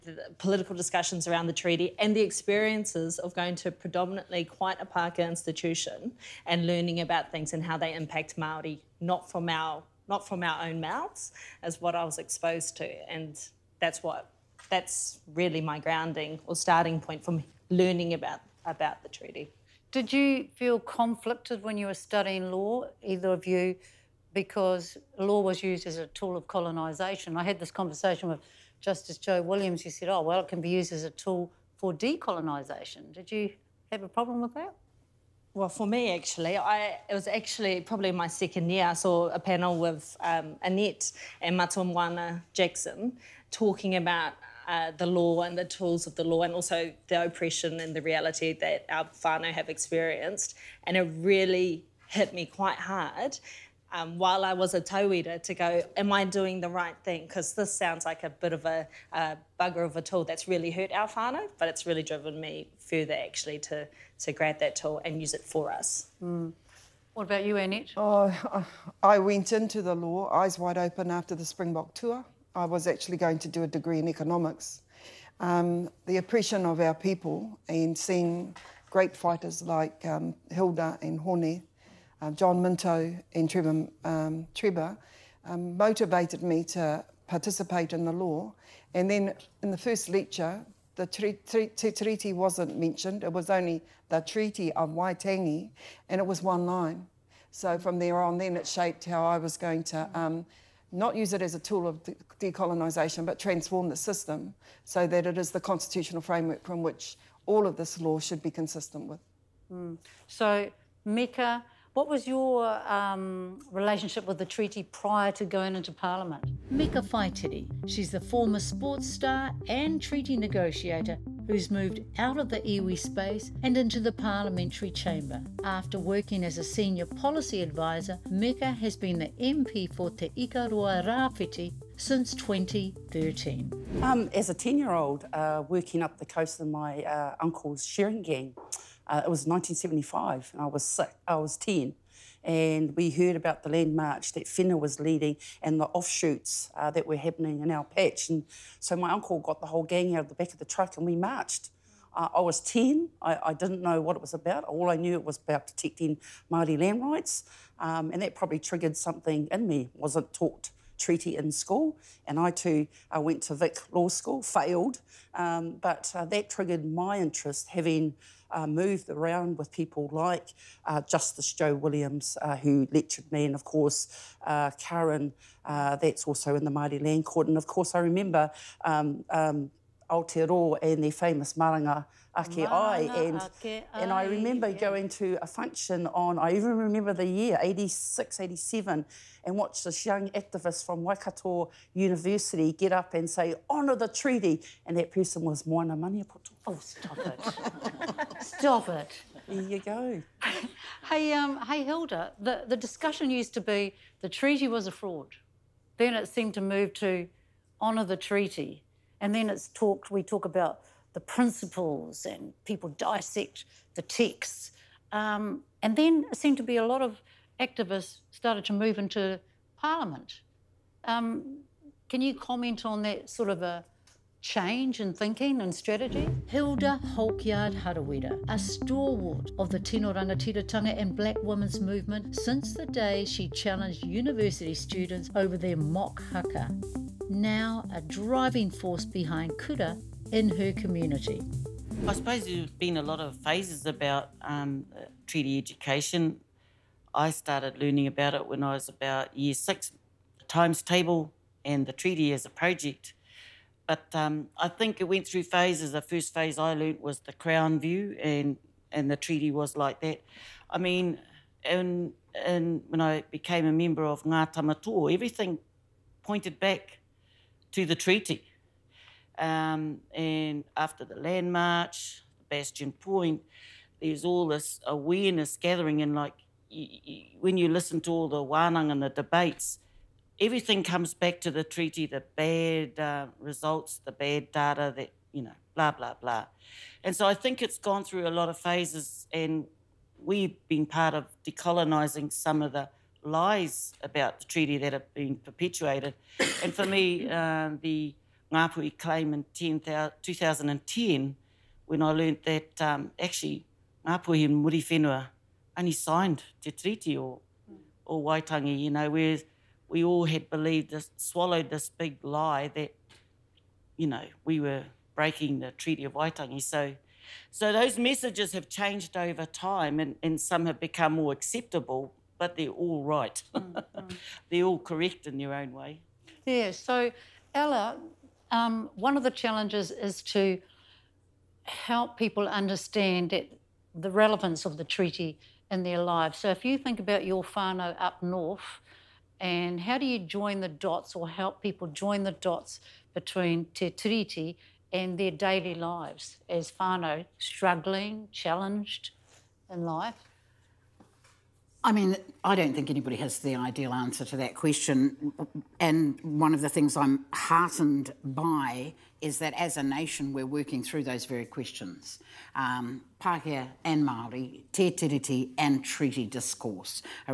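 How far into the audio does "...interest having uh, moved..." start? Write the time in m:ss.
2:47.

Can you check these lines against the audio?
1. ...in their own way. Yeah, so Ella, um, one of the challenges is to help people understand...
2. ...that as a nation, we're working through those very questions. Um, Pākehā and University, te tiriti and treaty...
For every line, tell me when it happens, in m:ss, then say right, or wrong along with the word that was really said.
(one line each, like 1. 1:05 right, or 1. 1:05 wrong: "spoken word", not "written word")
1. 5:25 right
2. 5:59 wrong: "Māori", not "University".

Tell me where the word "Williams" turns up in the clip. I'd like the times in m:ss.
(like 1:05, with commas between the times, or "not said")
0:29, 2:51.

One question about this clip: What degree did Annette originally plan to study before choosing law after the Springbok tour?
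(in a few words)
Economics.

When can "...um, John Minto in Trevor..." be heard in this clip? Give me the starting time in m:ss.
1:22.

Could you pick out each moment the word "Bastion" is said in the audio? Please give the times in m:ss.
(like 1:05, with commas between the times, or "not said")
4:32.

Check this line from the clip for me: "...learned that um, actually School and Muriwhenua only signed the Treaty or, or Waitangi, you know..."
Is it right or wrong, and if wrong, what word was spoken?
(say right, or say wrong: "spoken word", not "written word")
wrong: "Ngāpuhi", not "School".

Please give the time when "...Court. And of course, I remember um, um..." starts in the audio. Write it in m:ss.
2:57.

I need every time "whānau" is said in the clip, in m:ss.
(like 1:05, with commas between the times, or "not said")
0:49, 1:01, 5:37, 5:46.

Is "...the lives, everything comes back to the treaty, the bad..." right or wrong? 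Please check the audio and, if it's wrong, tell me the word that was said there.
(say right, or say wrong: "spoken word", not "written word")
wrong: "debates", not "lives".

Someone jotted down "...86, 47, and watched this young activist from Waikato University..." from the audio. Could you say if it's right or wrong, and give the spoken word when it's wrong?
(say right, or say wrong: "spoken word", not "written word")
wrong: "87", not "47".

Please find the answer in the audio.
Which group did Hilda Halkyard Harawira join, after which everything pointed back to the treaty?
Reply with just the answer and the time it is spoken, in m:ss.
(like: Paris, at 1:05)
Ngā Tamatoa, at 4:24.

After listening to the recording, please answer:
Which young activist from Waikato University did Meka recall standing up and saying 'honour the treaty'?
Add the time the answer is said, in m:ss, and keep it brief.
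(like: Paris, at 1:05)
Moana Maniapoto, at 3:15.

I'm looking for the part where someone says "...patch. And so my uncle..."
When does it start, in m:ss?
2:27.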